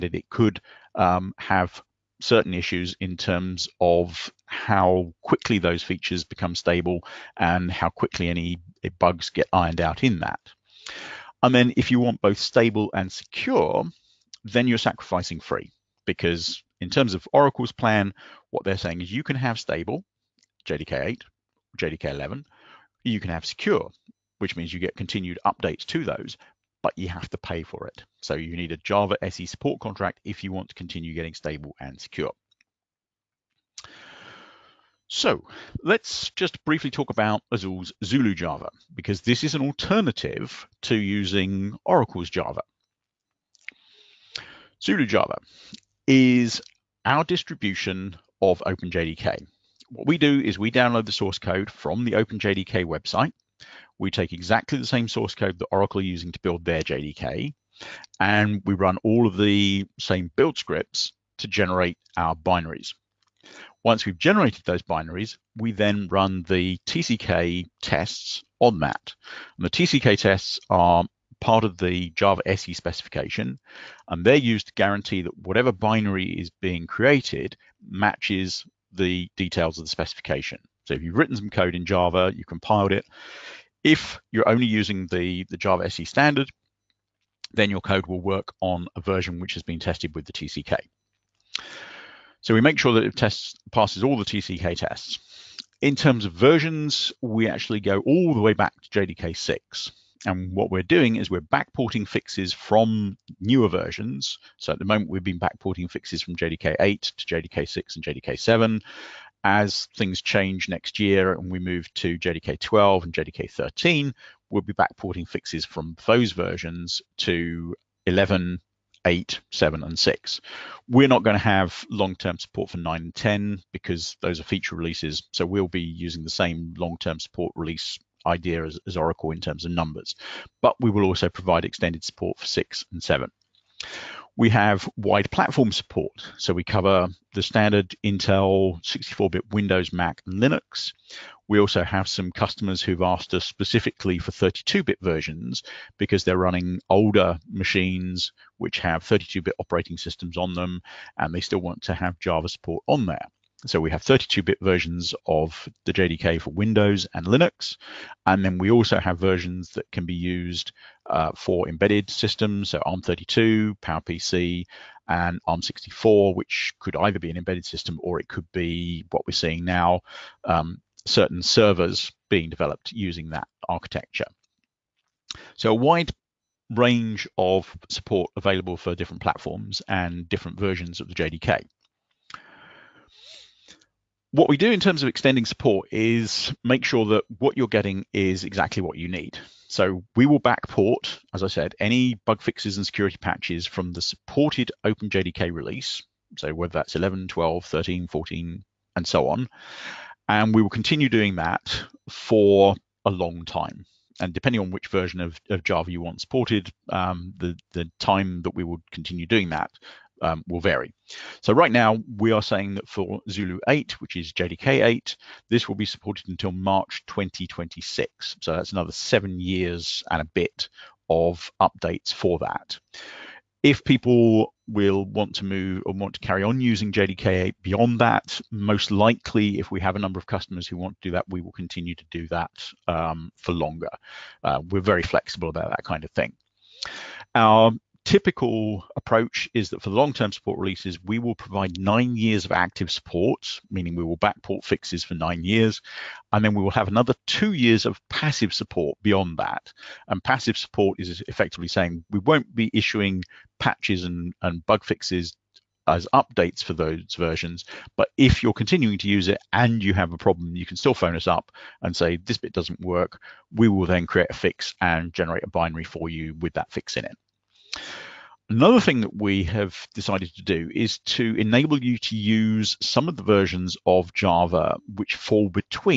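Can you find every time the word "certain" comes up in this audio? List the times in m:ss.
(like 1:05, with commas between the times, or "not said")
0:02, 2:51.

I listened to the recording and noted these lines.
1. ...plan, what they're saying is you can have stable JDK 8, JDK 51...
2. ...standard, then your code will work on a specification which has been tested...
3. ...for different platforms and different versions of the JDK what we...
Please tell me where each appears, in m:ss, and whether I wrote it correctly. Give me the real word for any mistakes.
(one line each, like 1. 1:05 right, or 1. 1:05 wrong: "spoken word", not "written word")
1. 0:17 wrong: "11", not "51"
2. 1:26 wrong: "version", not "specification"
3. 2:58 right.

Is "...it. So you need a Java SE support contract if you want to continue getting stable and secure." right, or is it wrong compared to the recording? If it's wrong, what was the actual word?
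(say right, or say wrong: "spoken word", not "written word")
right.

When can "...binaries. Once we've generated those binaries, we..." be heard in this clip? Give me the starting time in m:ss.
1:02.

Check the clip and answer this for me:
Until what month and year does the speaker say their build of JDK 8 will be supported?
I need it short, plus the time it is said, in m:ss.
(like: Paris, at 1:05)
March 2026, at 3:36.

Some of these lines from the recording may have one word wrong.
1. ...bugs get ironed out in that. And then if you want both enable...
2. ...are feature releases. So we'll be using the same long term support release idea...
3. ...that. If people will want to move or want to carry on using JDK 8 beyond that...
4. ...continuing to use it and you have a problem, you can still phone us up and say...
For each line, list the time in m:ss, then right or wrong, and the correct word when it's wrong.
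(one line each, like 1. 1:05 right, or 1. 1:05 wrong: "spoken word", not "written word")
1. 0:08 wrong: "stable", not "enable"
2. 2:04 right
3. 3:42 right
4. 4:18 right.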